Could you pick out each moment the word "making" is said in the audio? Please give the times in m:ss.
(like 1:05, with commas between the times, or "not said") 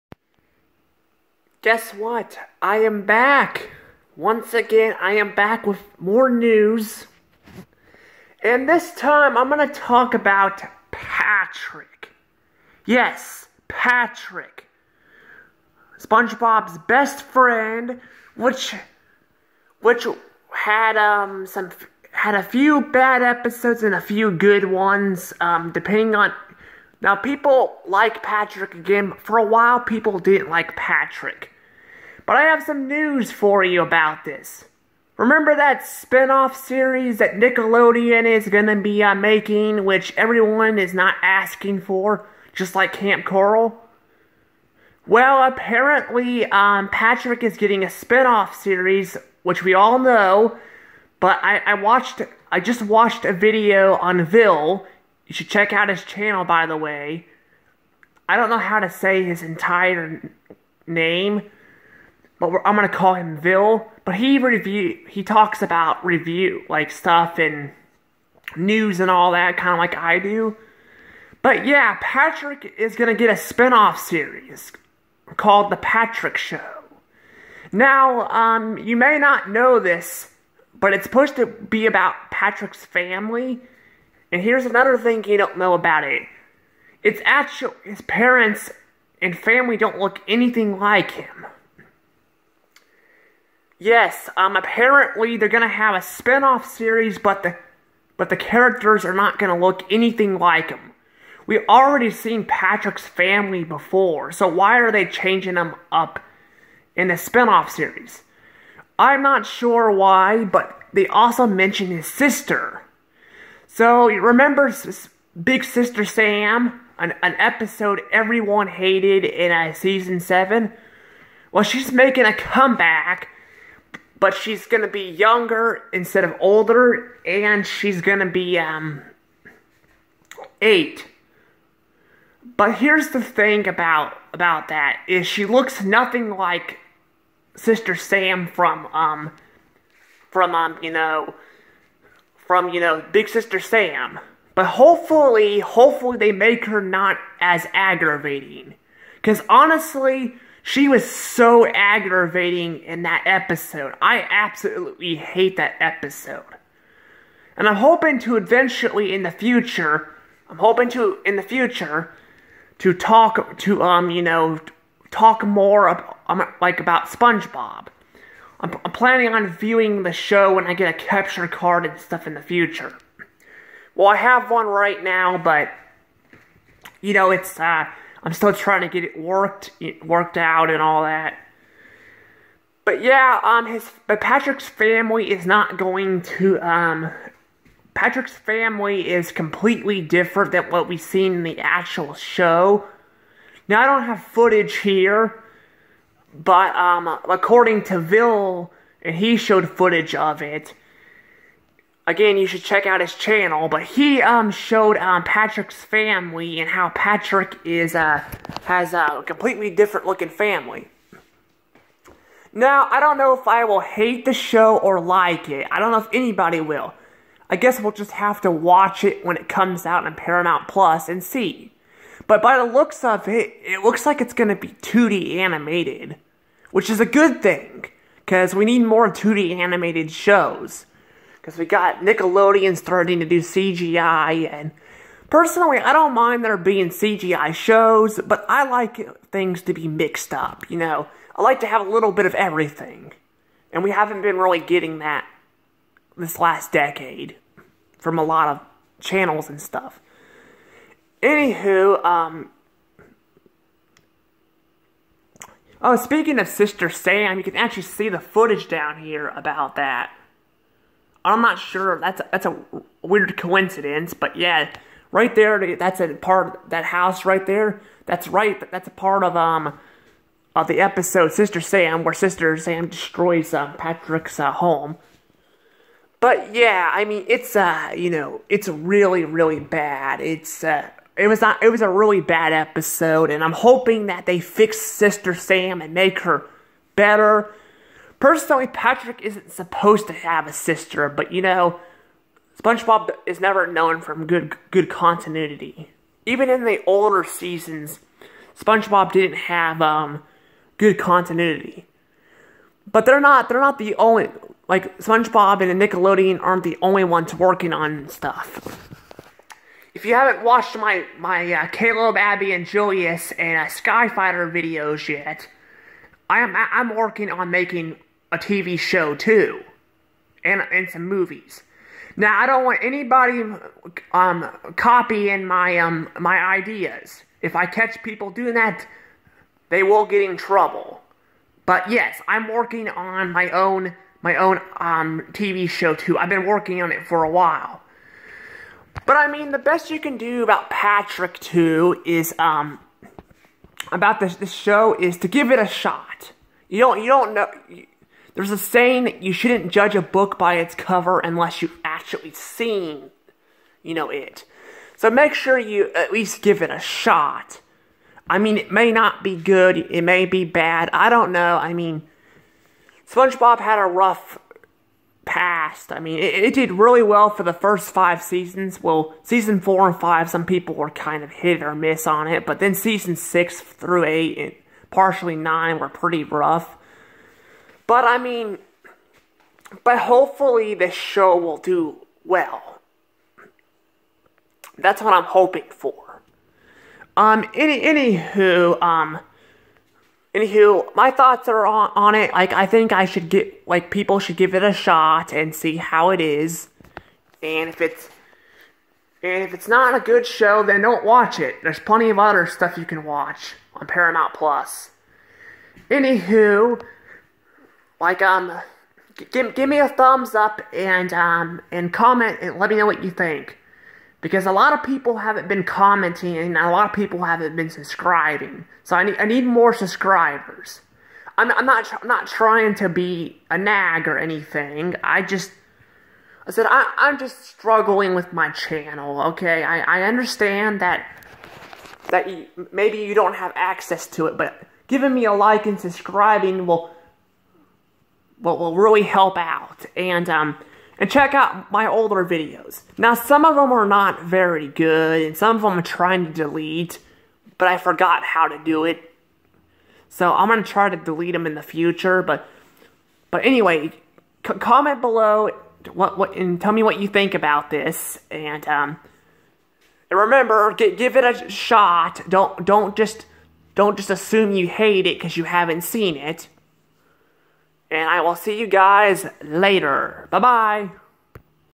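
0:39, 2:01, 5:17.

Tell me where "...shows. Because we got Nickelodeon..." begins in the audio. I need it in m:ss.
3:50.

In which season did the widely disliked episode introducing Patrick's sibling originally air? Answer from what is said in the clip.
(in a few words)
season 7.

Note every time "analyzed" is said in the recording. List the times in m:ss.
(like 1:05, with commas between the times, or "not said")
not said.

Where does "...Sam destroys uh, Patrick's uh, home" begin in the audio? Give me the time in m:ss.
4:32.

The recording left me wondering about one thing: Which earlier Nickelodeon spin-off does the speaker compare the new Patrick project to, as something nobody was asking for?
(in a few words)
Kamp Koral.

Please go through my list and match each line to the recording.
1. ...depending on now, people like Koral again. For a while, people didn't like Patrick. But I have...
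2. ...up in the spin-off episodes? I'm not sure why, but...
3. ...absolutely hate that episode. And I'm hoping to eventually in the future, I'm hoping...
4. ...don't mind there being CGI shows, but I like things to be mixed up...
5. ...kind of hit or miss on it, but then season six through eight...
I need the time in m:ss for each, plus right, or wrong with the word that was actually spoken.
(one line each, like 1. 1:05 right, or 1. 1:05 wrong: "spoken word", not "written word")
1. 0:25 wrong: "Patrick", not "Koral"
2. 1:45 wrong: "series", not "episodes"
3. 2:34 right
4. 3:55 right
5. 6:10 right.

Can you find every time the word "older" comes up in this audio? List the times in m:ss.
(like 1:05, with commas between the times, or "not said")
2:06, 4:56, 7:21.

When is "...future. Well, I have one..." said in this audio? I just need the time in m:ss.
2:52.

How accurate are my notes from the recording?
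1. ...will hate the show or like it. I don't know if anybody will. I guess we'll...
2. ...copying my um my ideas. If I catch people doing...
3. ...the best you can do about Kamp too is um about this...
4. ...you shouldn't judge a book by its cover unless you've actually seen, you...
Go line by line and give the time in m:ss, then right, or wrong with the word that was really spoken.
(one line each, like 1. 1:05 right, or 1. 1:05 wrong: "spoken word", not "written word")
1. 3:33 right
2. 5:24 right
3. 5:39 wrong: "Patrick", not "Kamp"
4. 5:49 right.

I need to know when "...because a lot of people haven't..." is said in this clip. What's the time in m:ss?
6:54.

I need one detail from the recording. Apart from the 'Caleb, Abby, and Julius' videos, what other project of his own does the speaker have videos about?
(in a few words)
Skyfighter.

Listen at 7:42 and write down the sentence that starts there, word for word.
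Don't don't just don't just assume you hate it because you haven't seen it.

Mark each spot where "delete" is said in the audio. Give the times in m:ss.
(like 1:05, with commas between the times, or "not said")
7:26, 7:30.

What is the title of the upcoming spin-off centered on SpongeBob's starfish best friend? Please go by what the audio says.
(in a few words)
The Patrick Show.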